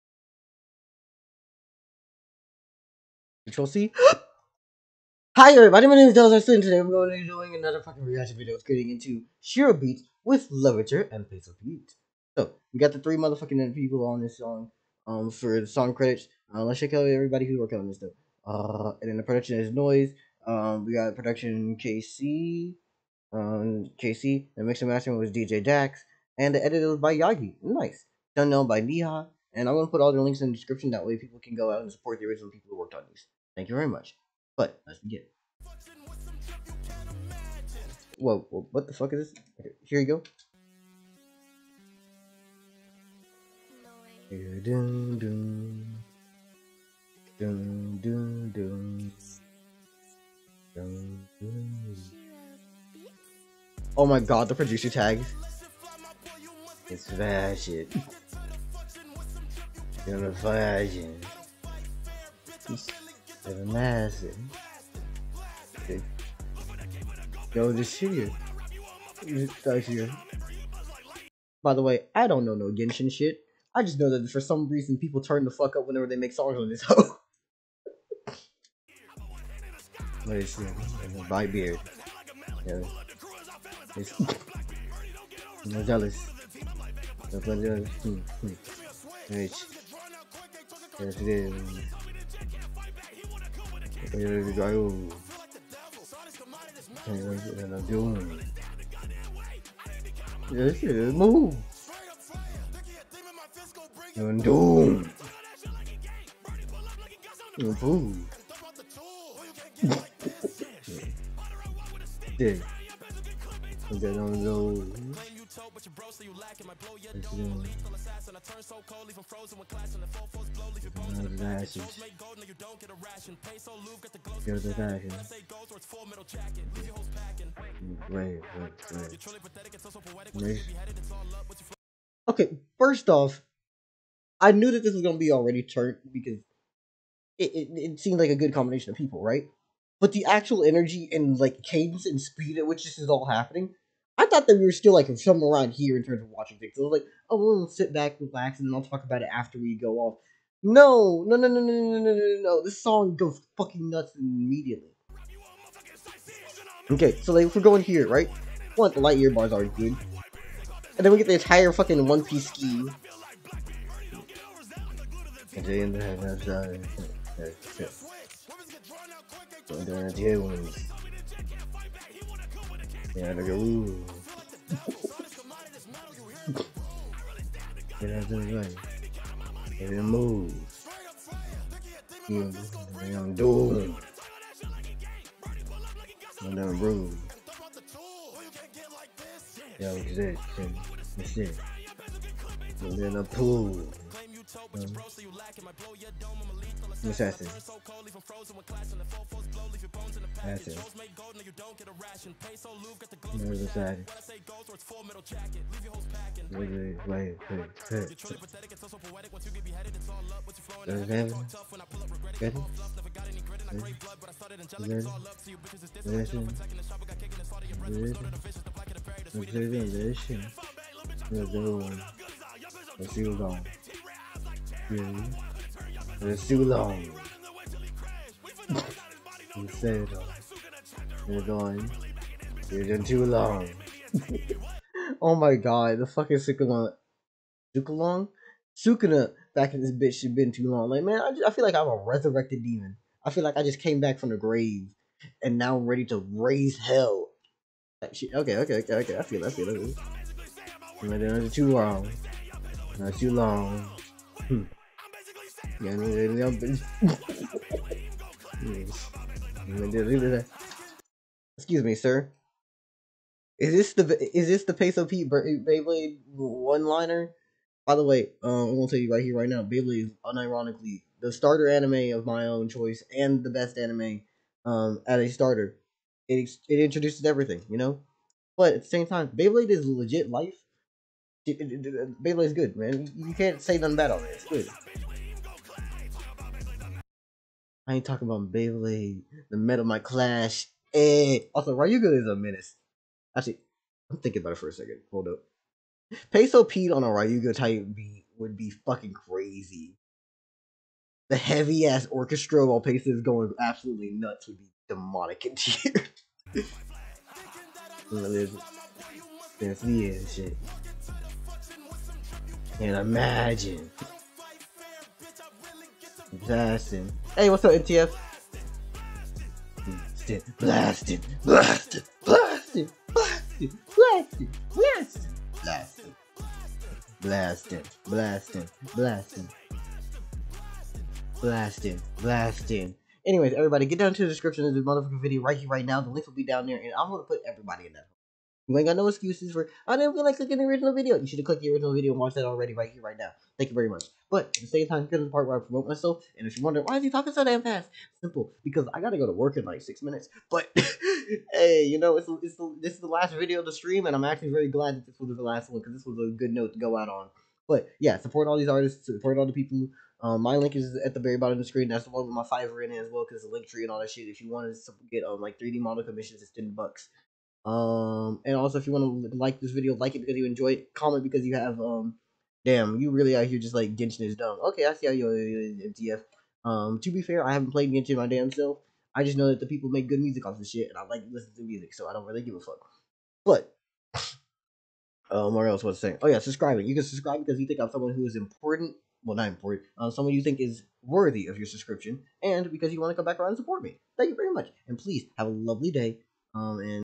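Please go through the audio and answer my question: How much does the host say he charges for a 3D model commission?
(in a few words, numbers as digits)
$10.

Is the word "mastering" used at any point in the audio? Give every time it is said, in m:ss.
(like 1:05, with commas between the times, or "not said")
0:24.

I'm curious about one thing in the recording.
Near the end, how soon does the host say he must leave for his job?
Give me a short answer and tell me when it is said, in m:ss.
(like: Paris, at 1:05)
6 minutes, at 5:49.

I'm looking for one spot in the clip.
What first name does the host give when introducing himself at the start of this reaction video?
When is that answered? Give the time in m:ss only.
0:06.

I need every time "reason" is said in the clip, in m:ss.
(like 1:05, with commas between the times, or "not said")
1:14.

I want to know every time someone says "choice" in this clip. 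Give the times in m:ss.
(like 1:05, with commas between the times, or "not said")
4:32.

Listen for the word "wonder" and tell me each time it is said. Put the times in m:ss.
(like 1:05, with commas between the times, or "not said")
5:46.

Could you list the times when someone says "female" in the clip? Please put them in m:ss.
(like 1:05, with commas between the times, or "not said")
not said.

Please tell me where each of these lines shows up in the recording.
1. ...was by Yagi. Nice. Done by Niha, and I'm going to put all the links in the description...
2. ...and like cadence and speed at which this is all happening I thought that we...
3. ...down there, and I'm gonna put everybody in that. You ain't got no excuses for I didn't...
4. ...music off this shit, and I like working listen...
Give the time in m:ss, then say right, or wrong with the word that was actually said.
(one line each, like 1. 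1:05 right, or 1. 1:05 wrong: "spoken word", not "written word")
1. 0:26 right
2. 2:21 right
3. 5:36 right
4. 6:20 wrong: "listening", not "working".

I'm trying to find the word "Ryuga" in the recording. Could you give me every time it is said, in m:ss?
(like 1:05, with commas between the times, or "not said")
4:51, 4:57.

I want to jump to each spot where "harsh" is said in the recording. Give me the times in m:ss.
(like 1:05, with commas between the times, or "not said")
not said.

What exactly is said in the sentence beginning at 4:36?
It it introduces everything, you know.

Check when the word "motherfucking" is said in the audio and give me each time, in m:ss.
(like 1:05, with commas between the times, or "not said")
0:13, 5:34.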